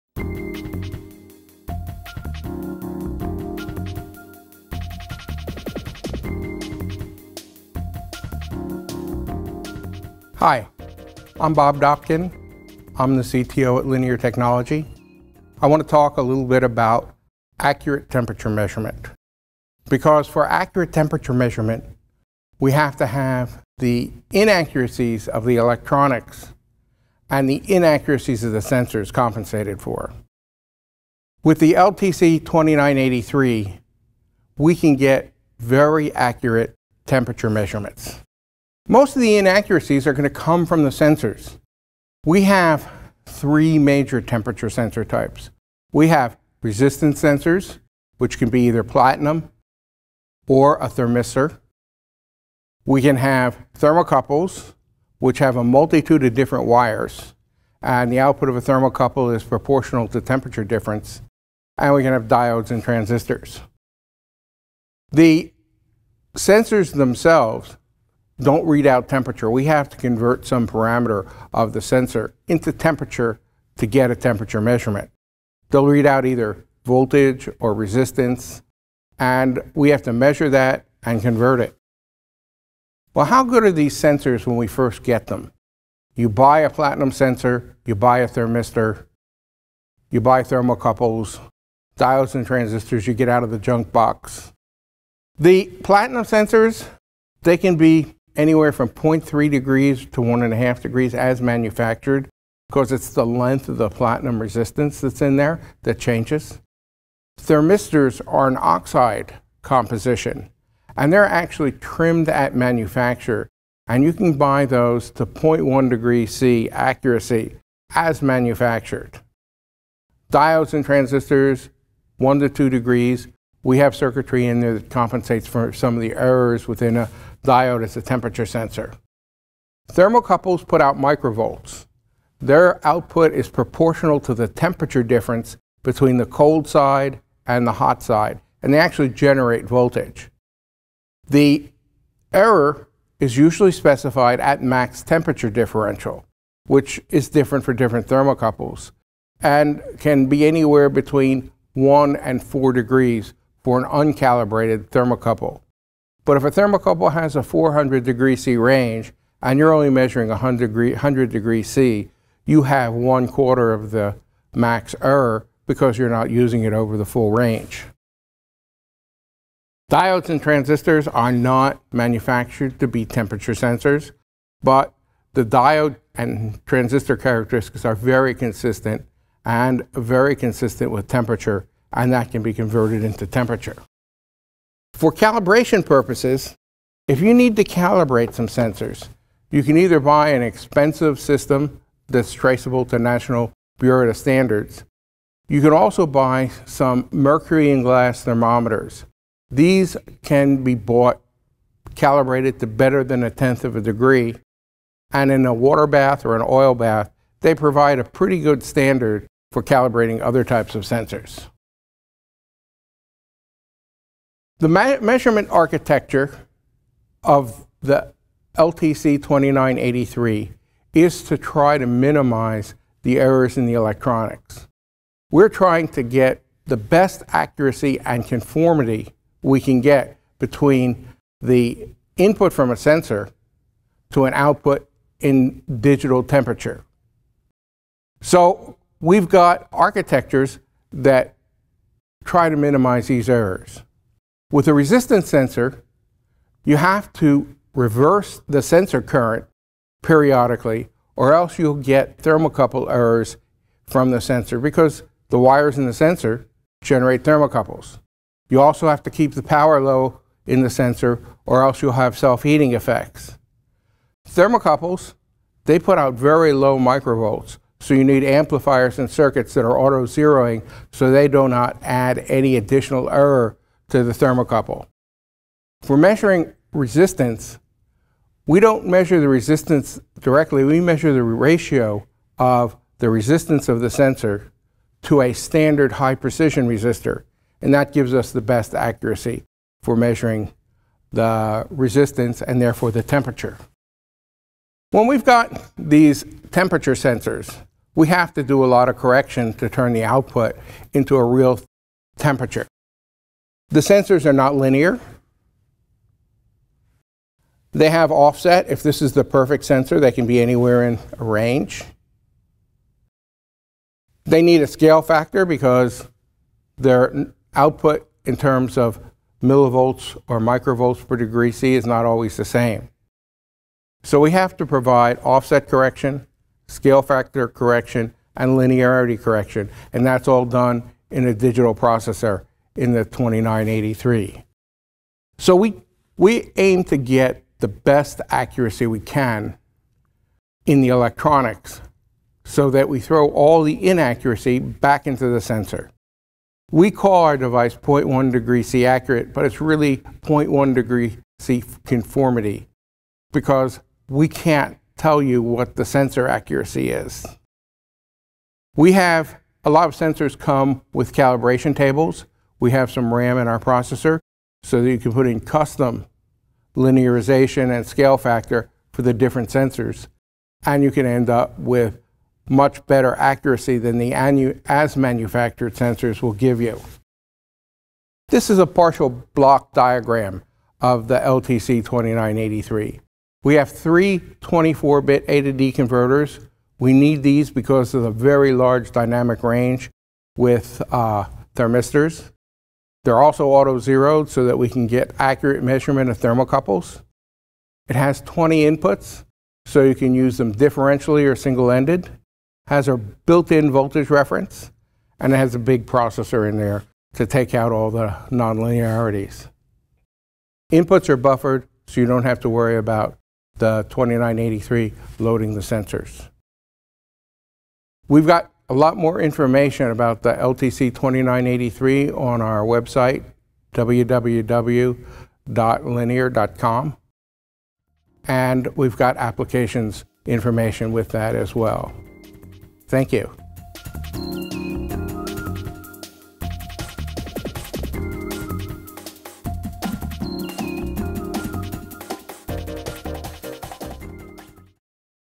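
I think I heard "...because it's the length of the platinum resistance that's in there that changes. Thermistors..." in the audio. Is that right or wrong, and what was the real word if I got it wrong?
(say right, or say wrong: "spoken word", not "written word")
right.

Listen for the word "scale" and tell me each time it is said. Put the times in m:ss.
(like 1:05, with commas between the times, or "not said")
5:14, 5:26, 6:07.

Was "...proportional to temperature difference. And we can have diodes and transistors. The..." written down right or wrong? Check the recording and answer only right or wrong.
right.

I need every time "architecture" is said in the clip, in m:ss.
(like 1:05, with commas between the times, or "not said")
3:35, 3:59.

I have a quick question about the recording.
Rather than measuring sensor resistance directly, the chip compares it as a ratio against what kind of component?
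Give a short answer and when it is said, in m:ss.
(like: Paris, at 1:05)
high precision resistor, at 4:45.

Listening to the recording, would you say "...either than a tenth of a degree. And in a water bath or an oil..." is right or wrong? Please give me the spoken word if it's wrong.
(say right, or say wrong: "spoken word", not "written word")
wrong: "better", not "either".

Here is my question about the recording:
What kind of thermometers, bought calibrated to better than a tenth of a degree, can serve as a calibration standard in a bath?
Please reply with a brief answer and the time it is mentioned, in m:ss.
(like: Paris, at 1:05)
mercury and glass, at 3:17.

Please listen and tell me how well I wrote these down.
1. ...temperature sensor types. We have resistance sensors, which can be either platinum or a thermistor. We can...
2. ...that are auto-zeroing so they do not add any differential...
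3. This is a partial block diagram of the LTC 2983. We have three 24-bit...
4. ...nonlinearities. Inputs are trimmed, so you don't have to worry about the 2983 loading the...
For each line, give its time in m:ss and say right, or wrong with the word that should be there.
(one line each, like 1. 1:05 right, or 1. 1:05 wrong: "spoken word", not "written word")
1. 0:44 right
2. 4:29 wrong: "additional", not "differential"
3. 6:18 right
4. 6:48 wrong: "buffered", not "trimmed".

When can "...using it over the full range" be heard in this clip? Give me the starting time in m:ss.
2:46.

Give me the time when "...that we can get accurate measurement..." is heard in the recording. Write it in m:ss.
6:34.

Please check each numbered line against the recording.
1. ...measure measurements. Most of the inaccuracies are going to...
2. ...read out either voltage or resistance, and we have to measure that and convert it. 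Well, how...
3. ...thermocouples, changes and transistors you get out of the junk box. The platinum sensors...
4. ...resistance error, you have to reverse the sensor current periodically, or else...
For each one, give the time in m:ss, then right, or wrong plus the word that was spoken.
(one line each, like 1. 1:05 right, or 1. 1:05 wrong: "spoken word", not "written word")
1. 0:37 wrong: "temperature", not "measure"
2. 1:15 right
3. 1:30 wrong: "diodes", not "changes"
4. 4:04 wrong: "sensor", not "error".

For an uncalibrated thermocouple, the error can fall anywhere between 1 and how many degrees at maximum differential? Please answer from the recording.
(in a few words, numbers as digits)
4 degrees.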